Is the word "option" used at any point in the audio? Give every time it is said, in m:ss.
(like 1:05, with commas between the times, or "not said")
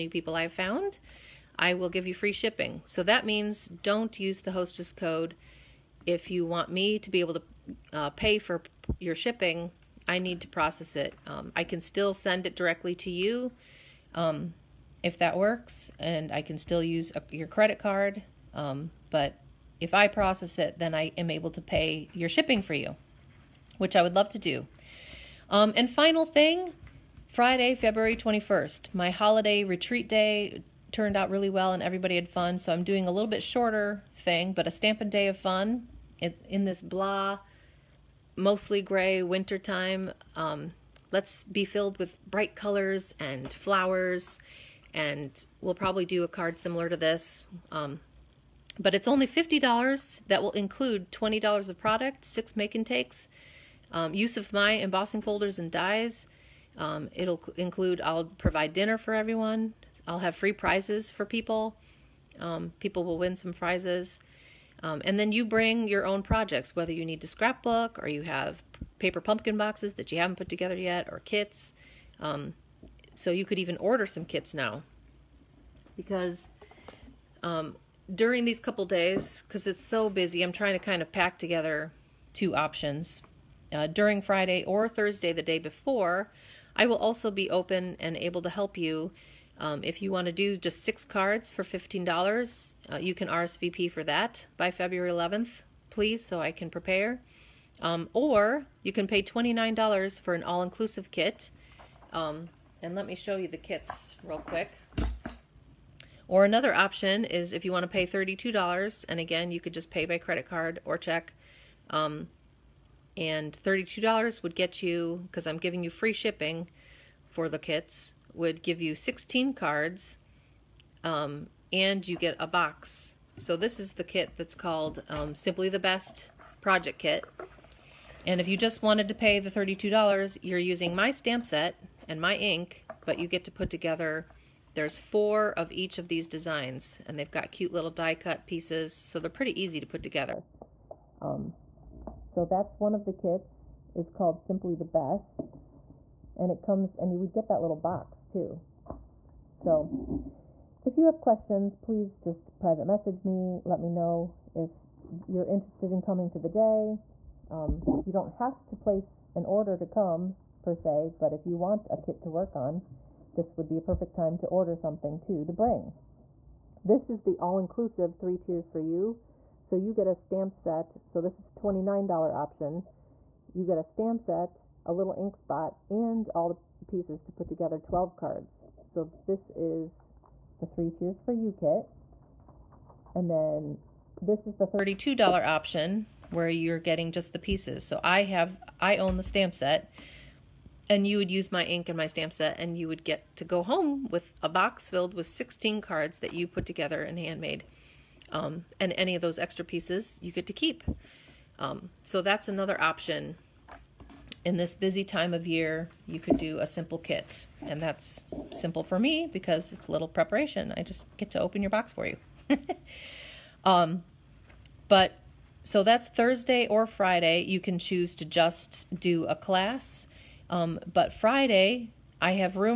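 1:22, 1:46, 2:52, 3:05, 3:22.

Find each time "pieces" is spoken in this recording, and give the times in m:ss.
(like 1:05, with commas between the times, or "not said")
2:18, 2:56, 3:07, 3:19.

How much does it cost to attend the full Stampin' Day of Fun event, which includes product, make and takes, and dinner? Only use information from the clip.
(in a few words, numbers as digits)
$50.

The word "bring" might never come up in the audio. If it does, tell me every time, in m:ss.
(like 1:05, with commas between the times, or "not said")
1:05, 2:45.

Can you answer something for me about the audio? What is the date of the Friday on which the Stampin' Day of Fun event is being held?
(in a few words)
February 21st.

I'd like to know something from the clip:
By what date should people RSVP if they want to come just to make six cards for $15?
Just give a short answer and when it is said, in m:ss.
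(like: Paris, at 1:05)
February 11th, at 1:34.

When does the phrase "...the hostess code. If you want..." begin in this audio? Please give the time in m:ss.
0:04.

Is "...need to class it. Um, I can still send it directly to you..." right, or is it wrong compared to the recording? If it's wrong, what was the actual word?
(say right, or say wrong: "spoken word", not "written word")
wrong: "process", not "class".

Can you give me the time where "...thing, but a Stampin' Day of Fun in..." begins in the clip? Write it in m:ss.
0:34.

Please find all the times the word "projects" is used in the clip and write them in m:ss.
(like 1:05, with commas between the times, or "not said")
1:06, 2:06.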